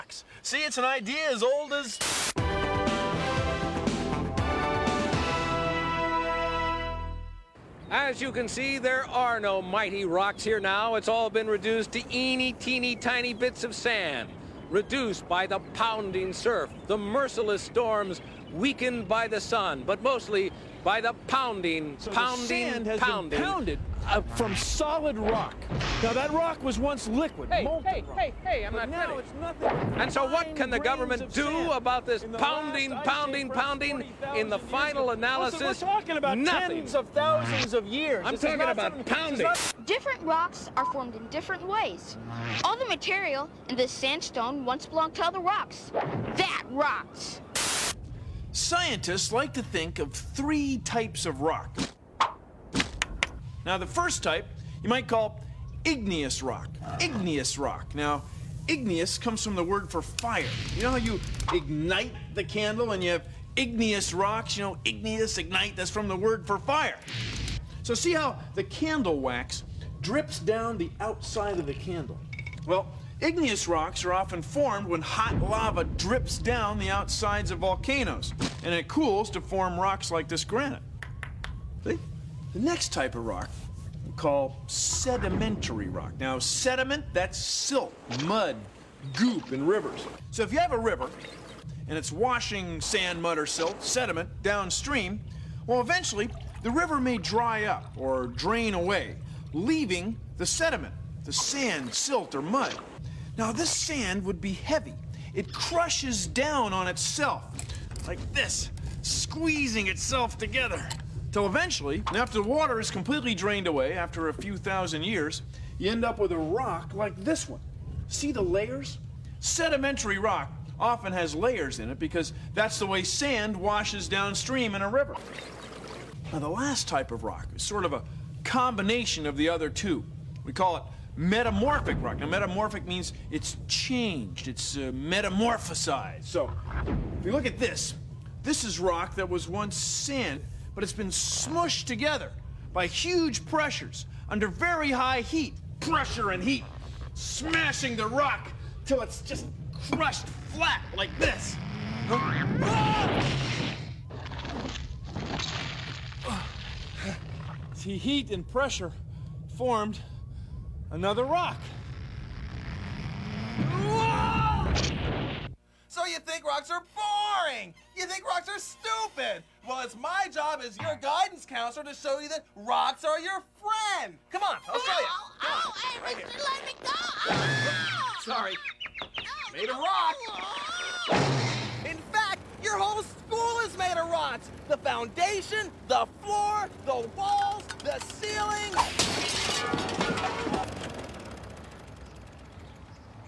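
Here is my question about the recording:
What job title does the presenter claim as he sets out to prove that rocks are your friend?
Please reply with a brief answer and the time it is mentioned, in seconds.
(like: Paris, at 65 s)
guidance counselor, at 171 s.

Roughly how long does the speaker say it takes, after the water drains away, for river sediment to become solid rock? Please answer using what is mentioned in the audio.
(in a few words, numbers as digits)
a few thousand years.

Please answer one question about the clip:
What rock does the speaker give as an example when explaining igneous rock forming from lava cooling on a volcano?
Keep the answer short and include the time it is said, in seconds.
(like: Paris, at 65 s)
granite, at 80 s.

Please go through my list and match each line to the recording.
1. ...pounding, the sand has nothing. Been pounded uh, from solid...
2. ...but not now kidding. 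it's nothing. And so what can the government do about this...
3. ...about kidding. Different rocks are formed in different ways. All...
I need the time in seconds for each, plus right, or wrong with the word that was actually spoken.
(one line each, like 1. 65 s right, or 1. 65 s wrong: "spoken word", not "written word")
1. 22 s wrong: "pounding", not "nothing"
2. 28 s right
3. 38 s wrong: "pounding", not "kidding".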